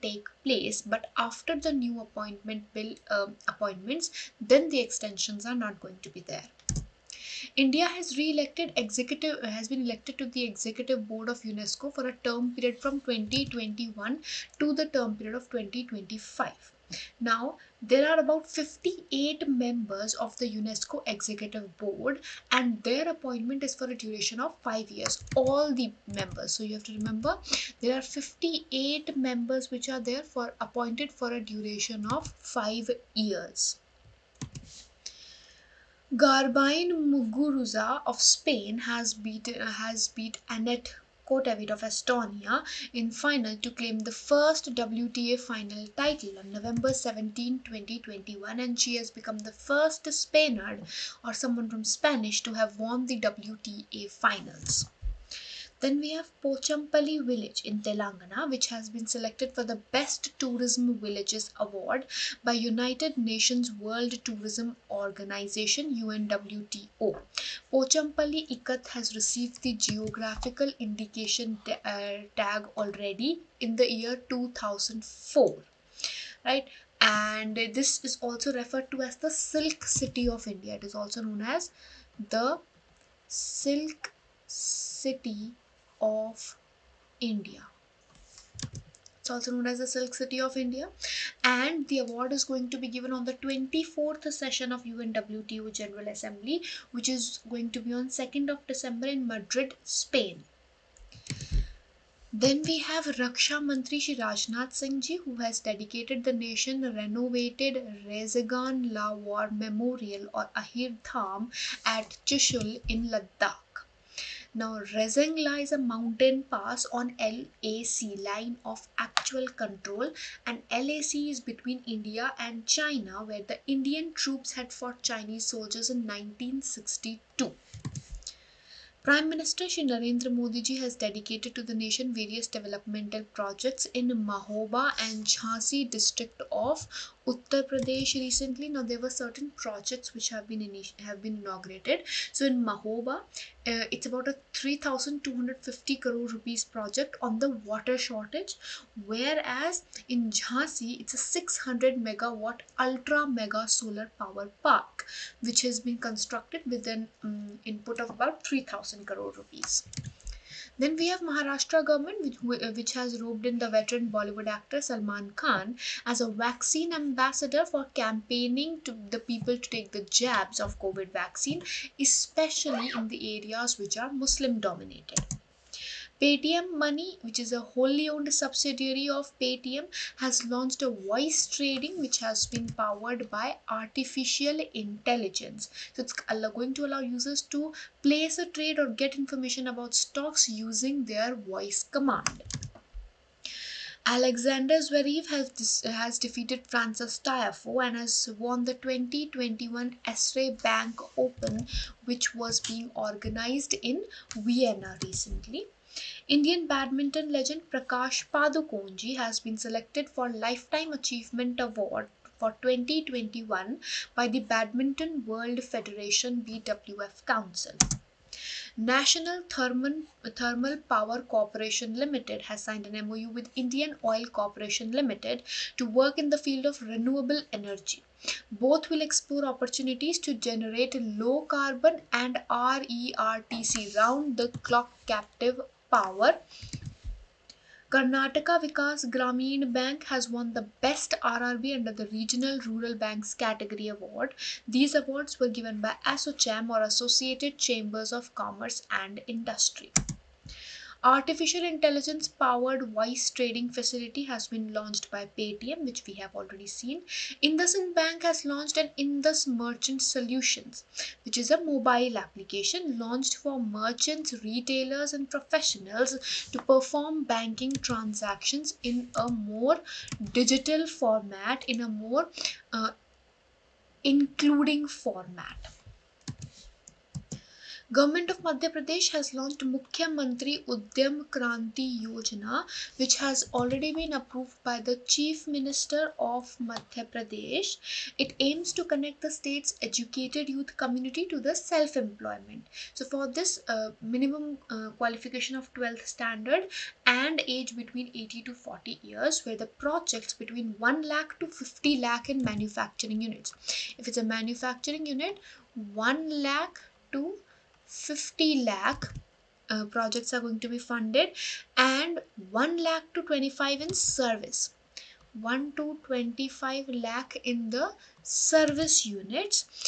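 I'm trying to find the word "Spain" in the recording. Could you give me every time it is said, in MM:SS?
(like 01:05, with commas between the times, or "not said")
00:38, 01:39.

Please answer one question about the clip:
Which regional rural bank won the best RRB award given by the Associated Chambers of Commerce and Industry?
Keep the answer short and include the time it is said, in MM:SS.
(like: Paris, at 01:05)
Karnataka Vikas Grameen Bank, at 03:57.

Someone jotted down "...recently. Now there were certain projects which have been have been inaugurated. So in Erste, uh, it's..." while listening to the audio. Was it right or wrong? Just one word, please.
wrong.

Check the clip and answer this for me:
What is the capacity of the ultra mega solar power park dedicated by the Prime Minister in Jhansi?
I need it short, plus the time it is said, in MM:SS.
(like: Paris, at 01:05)
600 megawatt, at 02:31.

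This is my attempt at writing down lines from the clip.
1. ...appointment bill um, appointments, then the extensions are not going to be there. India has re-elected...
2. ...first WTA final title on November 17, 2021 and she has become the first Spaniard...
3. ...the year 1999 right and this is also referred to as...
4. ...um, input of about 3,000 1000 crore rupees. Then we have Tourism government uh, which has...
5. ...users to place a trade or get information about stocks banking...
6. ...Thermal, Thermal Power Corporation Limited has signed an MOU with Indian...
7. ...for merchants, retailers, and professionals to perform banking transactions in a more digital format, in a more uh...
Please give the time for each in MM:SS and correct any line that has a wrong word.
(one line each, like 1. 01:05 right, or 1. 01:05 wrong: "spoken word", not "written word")
1. 00:01 right
2. 00:44 right
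3. 01:13 wrong: "2004", not "1999"
4. 02:37 wrong: "Maharashtra", not "Tourism"
5. 03:06 wrong: "using", not "banking"
6. 03:39 right
7. 04:23 right.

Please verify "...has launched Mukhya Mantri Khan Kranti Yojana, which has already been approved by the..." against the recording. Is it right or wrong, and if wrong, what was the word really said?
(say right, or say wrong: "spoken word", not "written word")
wrong: "Udyam", not "Khan".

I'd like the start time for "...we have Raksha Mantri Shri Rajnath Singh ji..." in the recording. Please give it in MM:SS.
01:42.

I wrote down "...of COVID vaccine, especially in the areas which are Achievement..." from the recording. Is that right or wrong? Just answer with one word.
wrong.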